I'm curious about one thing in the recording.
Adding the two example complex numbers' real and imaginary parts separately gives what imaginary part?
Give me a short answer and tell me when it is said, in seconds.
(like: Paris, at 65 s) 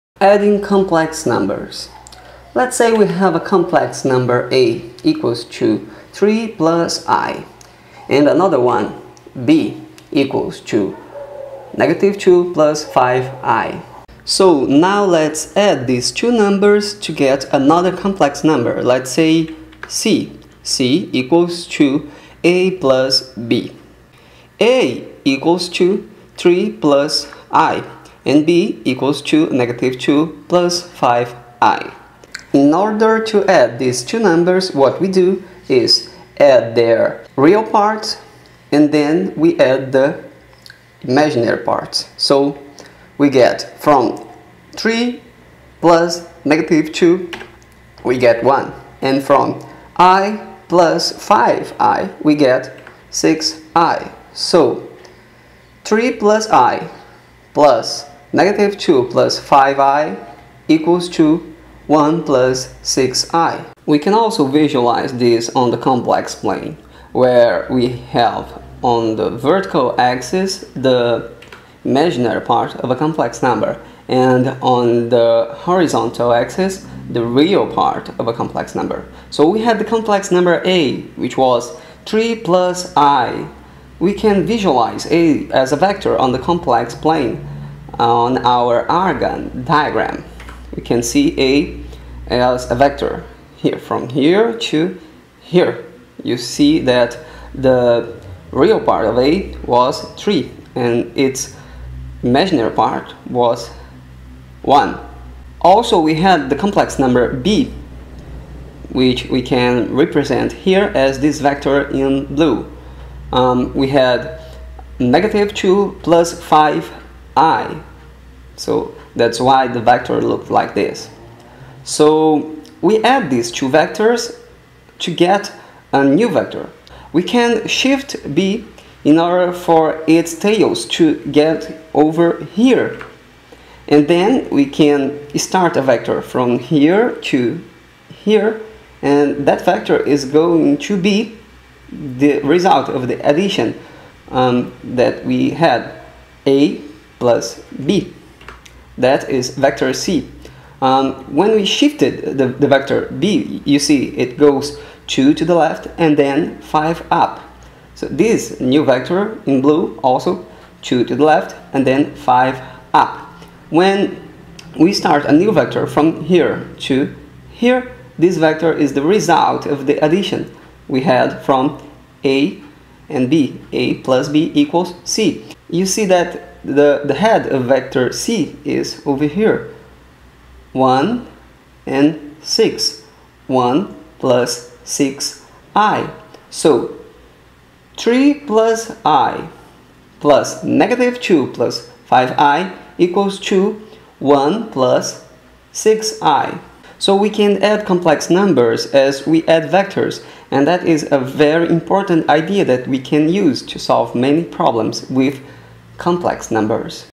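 6i, at 52 s.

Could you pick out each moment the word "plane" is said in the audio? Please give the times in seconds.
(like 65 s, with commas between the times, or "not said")
66 s, 86 s.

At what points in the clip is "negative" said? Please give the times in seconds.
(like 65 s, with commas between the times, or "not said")
11 s, 29 s, 46 s, 58 s, 114 s, 190 s.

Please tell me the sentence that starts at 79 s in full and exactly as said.
So we had the complex number a which was 3 plus i.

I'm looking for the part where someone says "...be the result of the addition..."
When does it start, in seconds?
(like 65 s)
140 s.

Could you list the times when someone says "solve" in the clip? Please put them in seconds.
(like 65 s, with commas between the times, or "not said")
203 s.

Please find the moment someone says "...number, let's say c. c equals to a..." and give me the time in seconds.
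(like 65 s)
18 s.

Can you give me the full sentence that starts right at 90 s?
We can see A as a vector here, from here to here.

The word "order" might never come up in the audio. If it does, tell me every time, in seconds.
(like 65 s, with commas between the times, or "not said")
32 s, 129 s.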